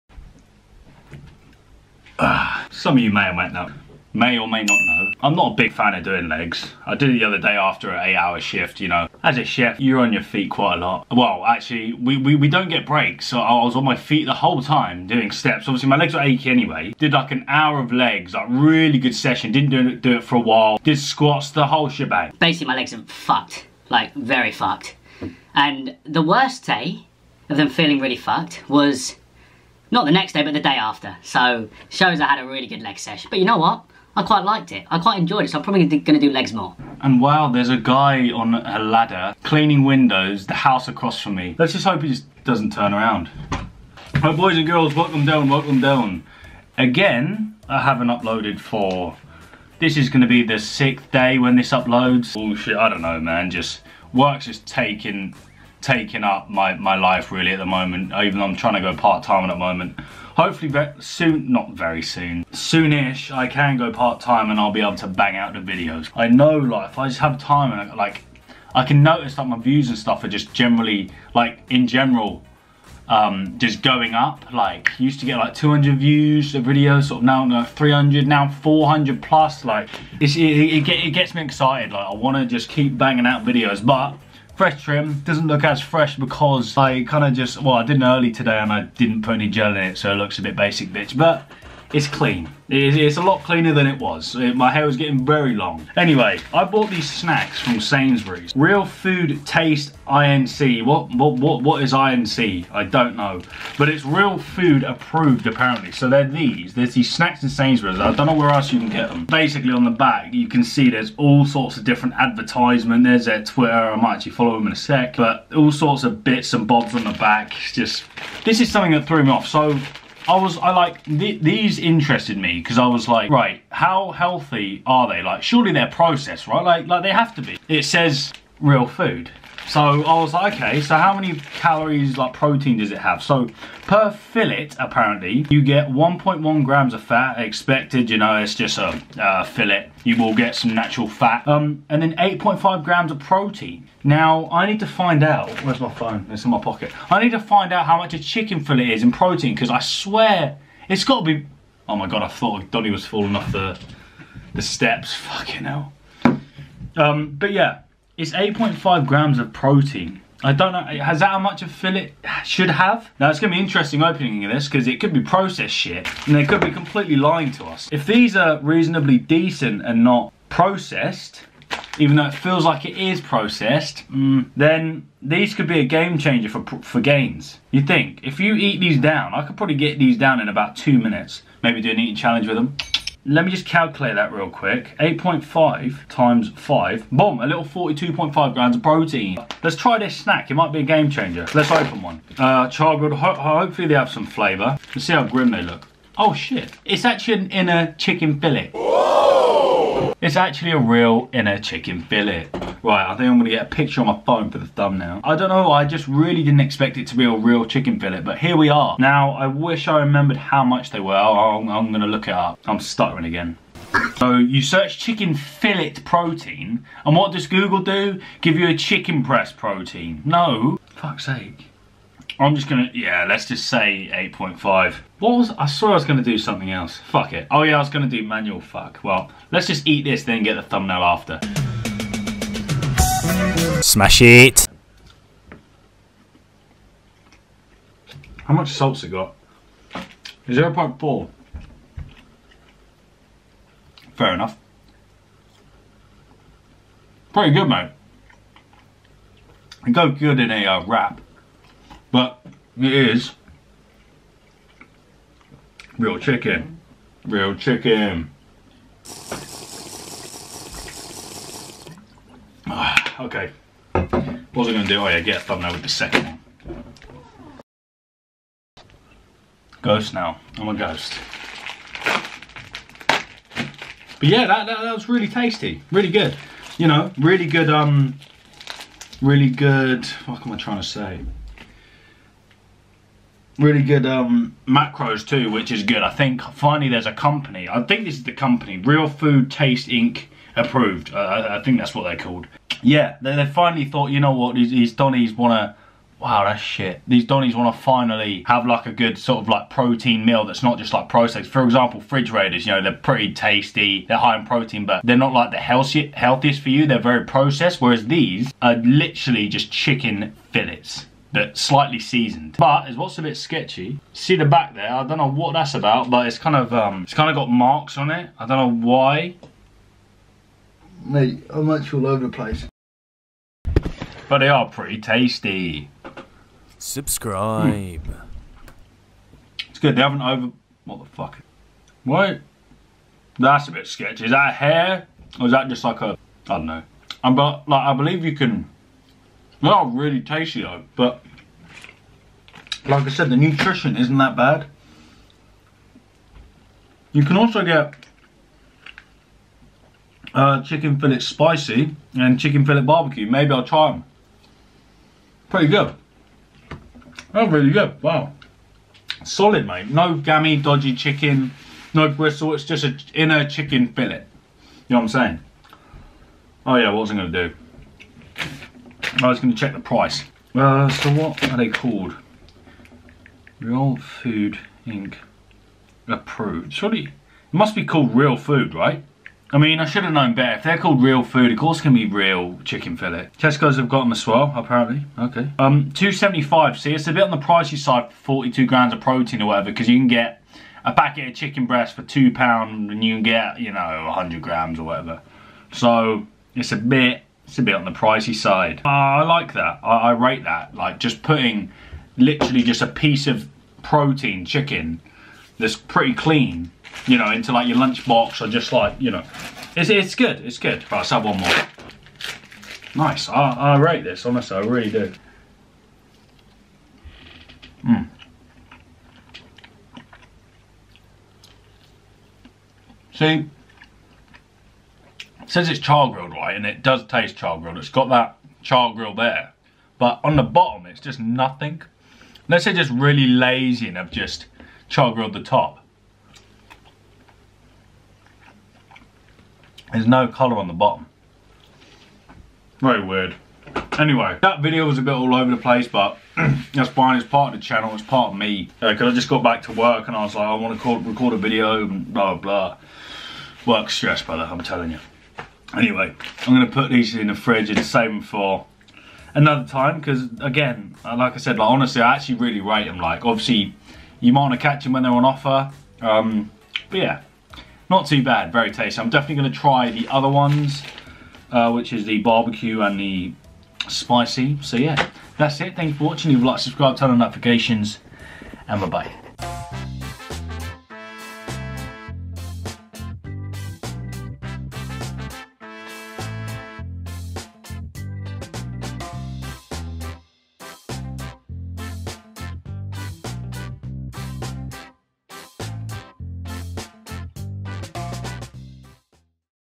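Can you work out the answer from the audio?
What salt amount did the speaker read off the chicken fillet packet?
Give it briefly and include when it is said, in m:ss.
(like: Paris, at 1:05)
0.4, at 4:00.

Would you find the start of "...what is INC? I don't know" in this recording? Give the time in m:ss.
1:41.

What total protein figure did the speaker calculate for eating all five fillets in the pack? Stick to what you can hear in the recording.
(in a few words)
42.5 grams.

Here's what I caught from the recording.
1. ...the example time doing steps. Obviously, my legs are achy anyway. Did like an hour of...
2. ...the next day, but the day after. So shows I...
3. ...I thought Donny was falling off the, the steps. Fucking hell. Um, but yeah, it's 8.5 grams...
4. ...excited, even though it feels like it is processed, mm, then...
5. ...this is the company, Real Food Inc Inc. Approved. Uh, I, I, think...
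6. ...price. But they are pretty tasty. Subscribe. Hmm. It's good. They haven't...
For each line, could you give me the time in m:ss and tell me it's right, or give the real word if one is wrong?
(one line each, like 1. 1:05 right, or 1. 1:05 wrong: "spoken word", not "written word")
1. 0:14 wrong: "whole", not "example"
2. 0:30 right
3. 2:32 right
4. 2:50 wrong: "processed", not "excited"
5. 4:48 wrong: "Taste", not "Inc"
6. 5:22 wrong: "place", not "price".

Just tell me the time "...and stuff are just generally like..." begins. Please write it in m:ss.
1:09.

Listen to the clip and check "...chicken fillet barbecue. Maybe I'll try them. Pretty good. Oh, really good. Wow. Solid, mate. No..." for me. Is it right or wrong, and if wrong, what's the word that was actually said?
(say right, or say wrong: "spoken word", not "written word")
right.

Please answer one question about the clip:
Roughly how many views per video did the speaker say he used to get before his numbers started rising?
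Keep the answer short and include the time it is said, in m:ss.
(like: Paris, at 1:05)
200, at 1:15.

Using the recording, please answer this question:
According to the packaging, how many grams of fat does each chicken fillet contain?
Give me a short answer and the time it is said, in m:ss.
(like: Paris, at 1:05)
1.1 grams, at 2:15.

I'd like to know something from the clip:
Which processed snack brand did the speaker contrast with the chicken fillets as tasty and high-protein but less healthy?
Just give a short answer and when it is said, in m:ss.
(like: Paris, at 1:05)
Fridge Raiders, at 5:01.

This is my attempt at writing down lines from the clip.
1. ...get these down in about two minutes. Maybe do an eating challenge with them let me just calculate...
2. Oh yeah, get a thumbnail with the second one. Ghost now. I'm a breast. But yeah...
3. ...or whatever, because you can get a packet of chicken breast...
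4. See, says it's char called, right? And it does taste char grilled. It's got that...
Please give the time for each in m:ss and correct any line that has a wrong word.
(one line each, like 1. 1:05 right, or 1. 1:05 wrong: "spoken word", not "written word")
1. 2:59 right
2. 4:24 wrong: "ghost", not "breast"
3. 6:29 right
4. 7:03 wrong: "grilled", not "called".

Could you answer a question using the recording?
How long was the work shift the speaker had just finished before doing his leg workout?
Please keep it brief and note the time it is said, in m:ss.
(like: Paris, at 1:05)
8 hours, at 0:08.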